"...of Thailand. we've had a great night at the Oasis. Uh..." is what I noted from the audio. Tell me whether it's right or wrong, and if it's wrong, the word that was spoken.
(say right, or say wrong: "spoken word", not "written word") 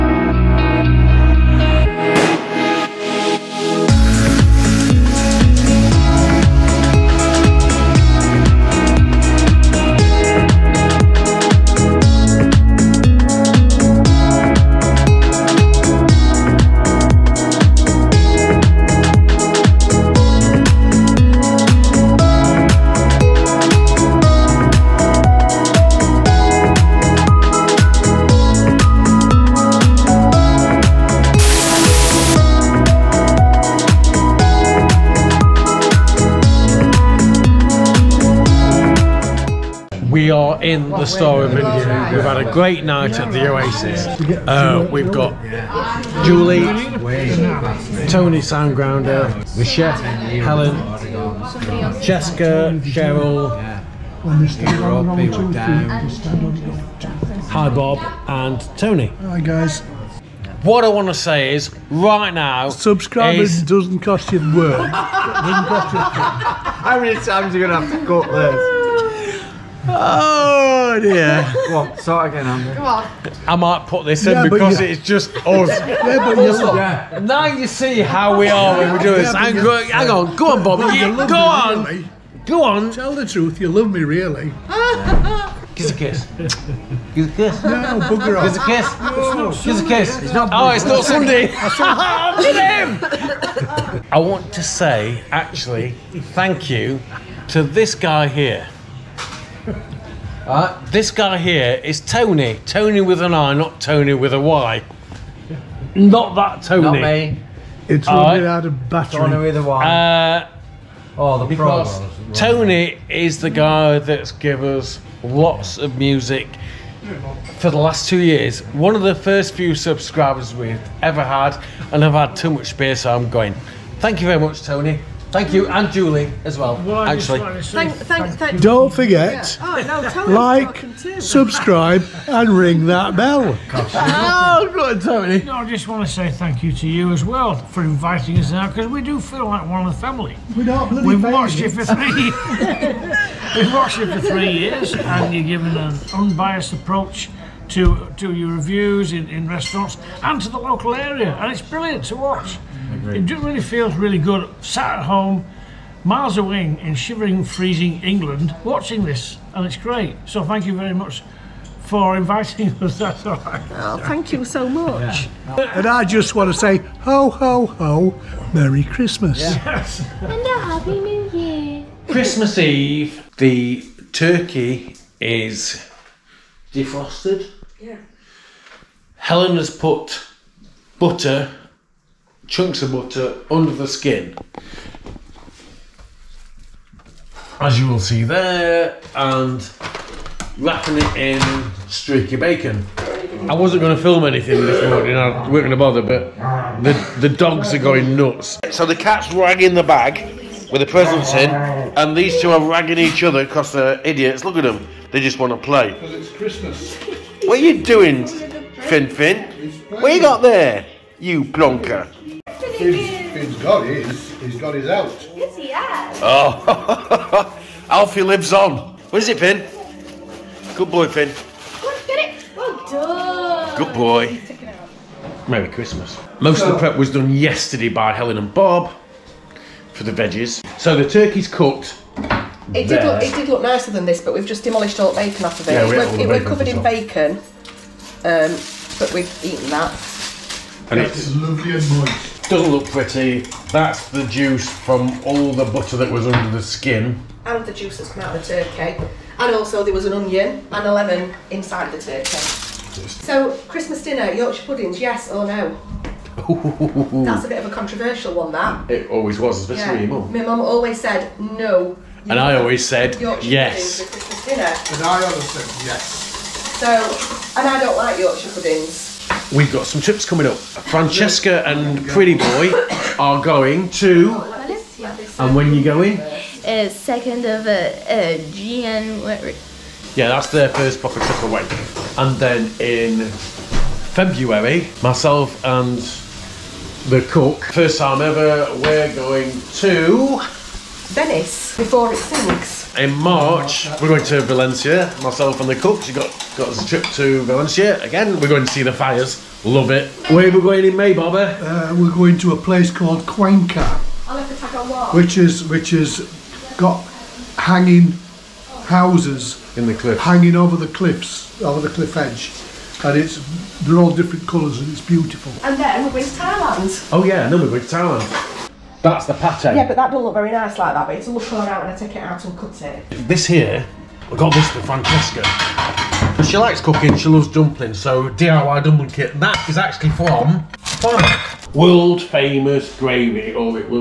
wrong: "India", not "Thailand".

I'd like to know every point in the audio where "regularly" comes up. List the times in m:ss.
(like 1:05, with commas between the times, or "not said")
not said.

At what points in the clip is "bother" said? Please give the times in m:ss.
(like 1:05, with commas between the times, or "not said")
3:15.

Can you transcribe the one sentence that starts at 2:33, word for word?
It really feels really good sat at home, miles away in shivering, freezing England, watching this, and it's great.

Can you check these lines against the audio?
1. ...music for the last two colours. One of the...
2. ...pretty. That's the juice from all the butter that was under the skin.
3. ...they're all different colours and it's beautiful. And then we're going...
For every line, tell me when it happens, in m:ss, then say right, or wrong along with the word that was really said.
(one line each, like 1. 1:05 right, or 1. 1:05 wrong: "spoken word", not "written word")
1. 1:55 wrong: "years", not "colours"
2. 4:02 right
3. 5:13 right.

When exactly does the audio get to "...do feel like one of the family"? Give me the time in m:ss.
2:19.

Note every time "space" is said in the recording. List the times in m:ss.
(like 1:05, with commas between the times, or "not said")
2:02.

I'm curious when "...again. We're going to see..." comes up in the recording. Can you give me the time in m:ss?
4:58.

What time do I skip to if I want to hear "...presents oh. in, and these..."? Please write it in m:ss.
3:20.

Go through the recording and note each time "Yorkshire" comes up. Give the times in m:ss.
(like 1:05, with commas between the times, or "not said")
4:14, 4:23, 4:28.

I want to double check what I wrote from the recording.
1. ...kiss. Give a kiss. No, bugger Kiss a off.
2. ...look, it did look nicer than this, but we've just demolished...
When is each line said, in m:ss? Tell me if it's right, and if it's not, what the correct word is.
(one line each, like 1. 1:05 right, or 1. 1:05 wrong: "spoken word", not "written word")
1. 1:25 right
2. 3:53 right.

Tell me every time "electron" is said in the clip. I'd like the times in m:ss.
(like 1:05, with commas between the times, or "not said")
not said.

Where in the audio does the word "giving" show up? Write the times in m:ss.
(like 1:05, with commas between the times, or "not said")
2:25.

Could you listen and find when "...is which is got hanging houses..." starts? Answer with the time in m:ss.
5:05.